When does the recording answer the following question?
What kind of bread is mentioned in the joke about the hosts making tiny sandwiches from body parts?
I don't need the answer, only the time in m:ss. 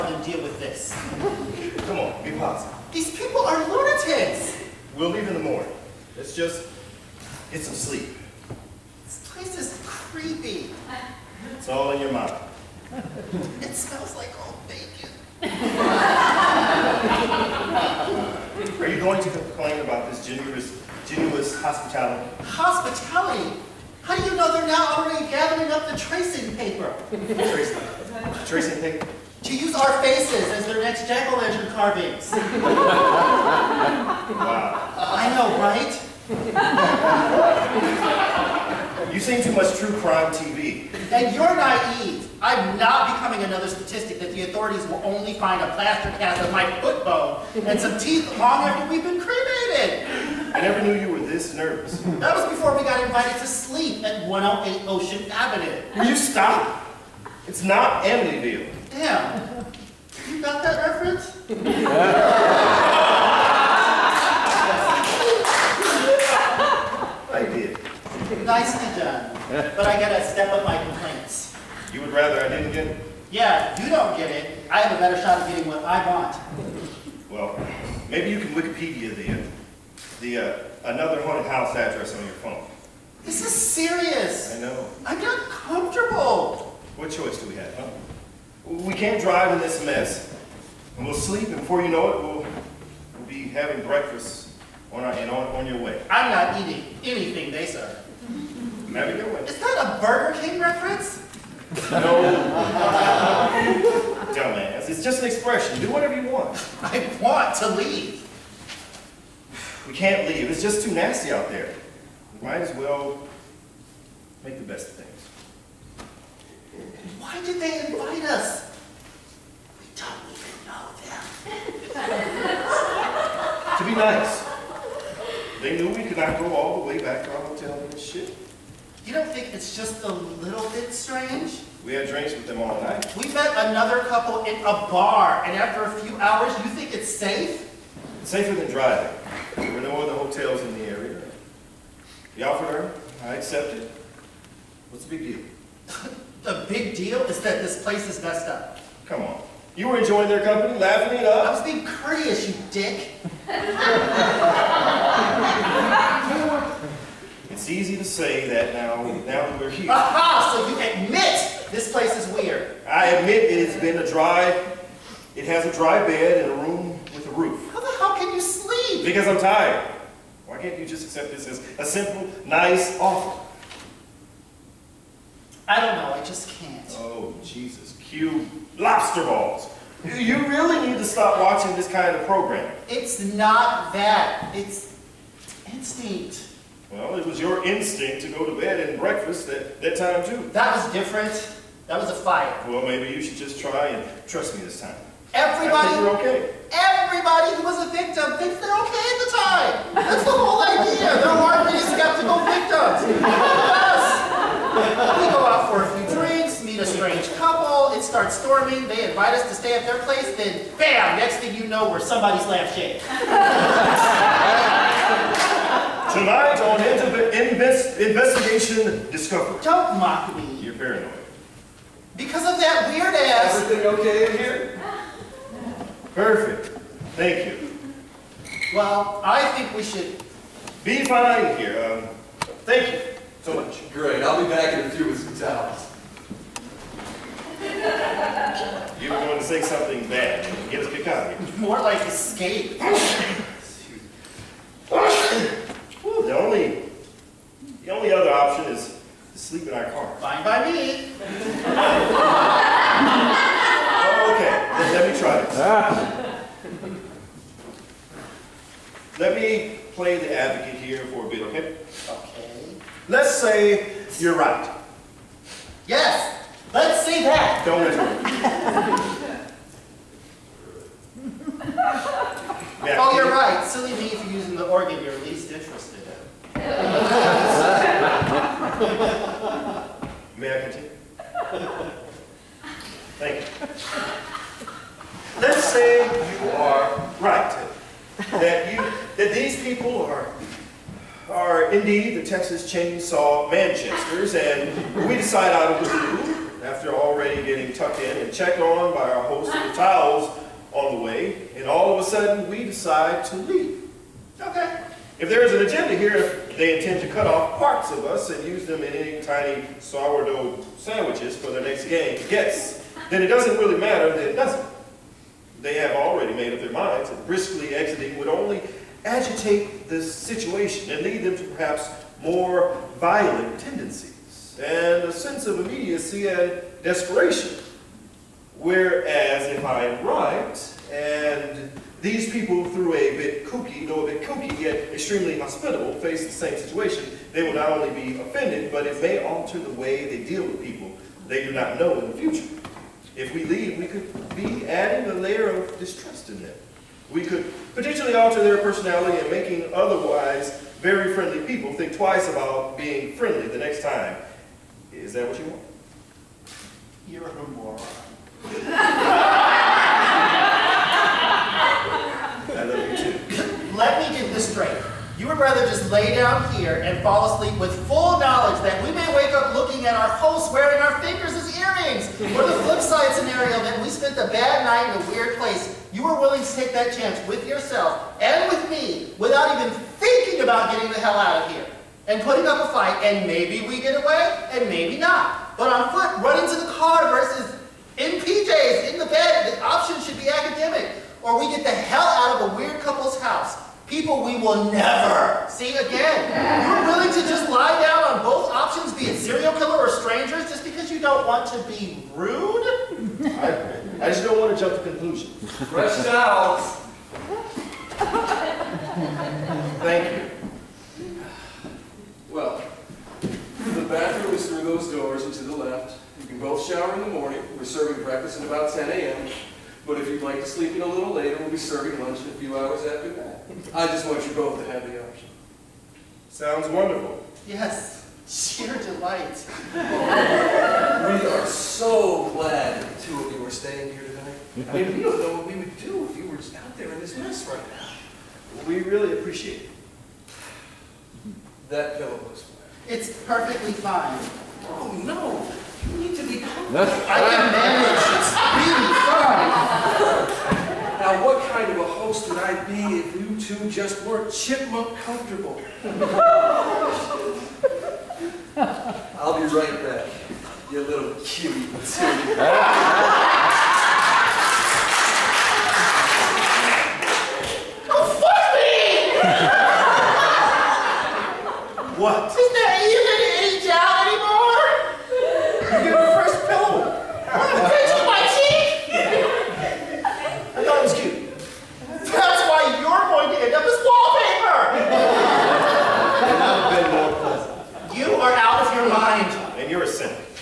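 5:09.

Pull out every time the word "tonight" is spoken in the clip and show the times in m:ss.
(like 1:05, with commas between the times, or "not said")
3:36, 7:14.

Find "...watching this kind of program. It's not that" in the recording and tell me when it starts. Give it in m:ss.
3:01.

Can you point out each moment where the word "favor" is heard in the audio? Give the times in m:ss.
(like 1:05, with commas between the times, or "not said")
not said.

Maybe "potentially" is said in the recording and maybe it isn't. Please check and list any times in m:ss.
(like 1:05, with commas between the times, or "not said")
5:47.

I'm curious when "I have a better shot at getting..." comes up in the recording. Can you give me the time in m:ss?
1:14.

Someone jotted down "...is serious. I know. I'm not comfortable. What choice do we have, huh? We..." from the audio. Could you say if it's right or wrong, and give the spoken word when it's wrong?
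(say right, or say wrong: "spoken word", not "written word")
right.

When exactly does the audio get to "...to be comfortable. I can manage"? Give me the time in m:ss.
7:26.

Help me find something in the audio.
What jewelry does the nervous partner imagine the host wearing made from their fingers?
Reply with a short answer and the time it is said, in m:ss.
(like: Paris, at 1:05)
earrings, at 6:11.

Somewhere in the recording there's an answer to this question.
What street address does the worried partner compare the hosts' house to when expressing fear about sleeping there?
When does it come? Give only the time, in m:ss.
0:54.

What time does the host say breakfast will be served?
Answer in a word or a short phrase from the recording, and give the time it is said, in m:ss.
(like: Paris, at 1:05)
10 a.m., at 6:58.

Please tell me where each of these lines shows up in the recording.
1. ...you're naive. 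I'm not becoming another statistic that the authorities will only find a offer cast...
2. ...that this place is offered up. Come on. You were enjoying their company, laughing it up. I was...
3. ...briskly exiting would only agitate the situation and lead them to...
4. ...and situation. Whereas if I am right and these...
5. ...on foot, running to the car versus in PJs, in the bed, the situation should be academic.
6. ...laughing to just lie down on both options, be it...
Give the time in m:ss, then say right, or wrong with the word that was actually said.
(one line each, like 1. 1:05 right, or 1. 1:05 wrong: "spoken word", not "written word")
1. 0:41 wrong: "plaster", not "offer"
2. 2:27 wrong: "messed", not "offered"
3. 5:17 right
4. 5:26 wrong: "desperation", not "situation"
5. 6:25 wrong: "option", not "situation"
6. 6:36 wrong: "willing", not "laughing".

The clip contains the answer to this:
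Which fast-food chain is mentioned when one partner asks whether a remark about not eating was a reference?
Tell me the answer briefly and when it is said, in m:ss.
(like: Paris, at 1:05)
Burger King, at 1:40.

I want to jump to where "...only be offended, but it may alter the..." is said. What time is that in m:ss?
5:37.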